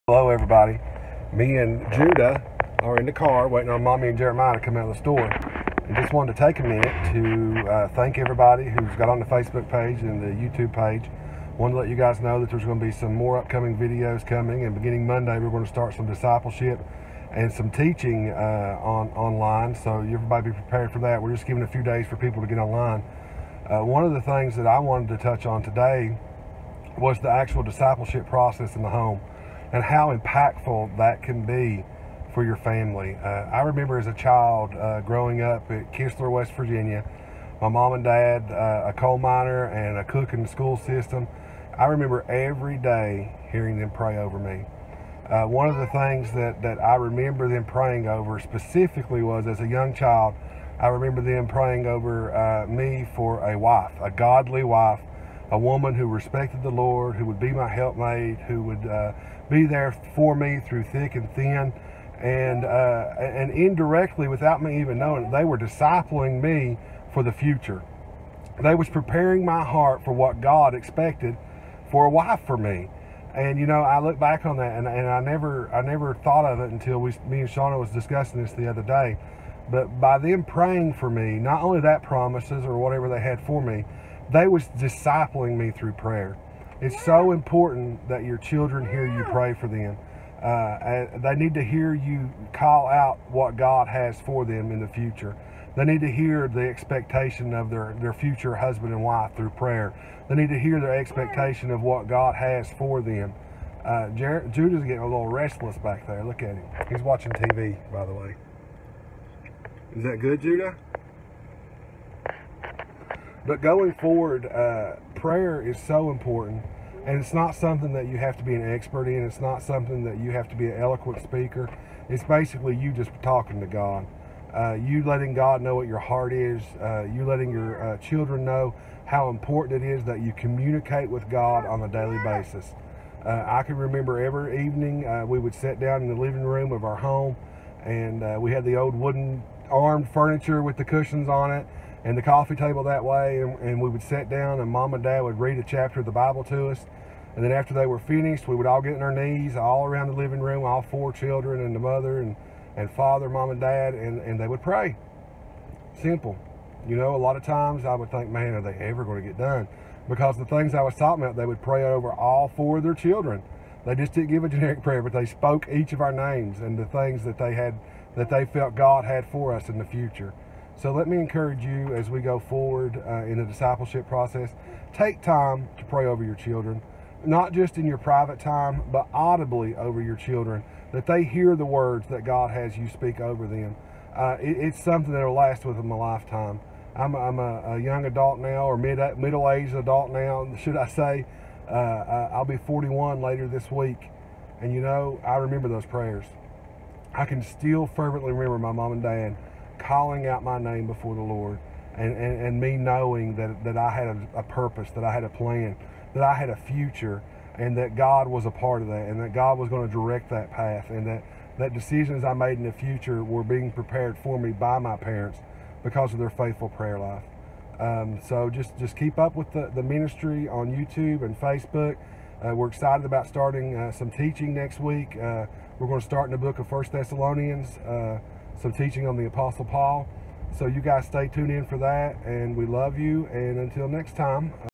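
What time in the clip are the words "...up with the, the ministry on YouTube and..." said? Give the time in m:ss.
3:39.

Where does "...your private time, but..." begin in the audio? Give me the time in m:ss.
2:57.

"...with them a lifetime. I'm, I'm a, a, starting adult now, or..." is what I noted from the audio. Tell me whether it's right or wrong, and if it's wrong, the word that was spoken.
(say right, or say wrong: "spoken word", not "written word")
wrong: "young", not "starting".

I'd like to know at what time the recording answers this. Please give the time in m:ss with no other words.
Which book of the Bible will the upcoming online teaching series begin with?
3:46.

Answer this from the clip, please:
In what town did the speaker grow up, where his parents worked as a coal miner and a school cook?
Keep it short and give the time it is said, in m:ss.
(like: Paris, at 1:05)
Kistler, West Virginia, at 0:35.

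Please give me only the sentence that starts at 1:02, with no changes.
And, uh, and indirectly, without me even knowing it, they were discipling me for the future.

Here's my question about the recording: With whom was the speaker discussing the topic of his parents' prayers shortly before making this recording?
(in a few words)
Shauna.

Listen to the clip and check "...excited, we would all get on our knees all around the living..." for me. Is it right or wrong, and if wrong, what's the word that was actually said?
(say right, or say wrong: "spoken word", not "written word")
wrong: "finished", not "excited".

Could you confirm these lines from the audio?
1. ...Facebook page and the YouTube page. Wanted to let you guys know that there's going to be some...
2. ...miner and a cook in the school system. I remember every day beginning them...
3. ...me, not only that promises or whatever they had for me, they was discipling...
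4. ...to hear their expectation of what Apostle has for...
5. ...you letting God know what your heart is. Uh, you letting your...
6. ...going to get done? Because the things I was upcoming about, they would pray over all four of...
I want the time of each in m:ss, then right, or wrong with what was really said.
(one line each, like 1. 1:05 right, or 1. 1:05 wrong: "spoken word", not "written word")
1. 0:09 right
2. 0:39 wrong: "hearing", not "beginning"
3. 1:21 right
4. 1:40 wrong: "God", not "Apostle"
5. 2:04 right
6. 2:39 wrong: "talking", not "upcoming".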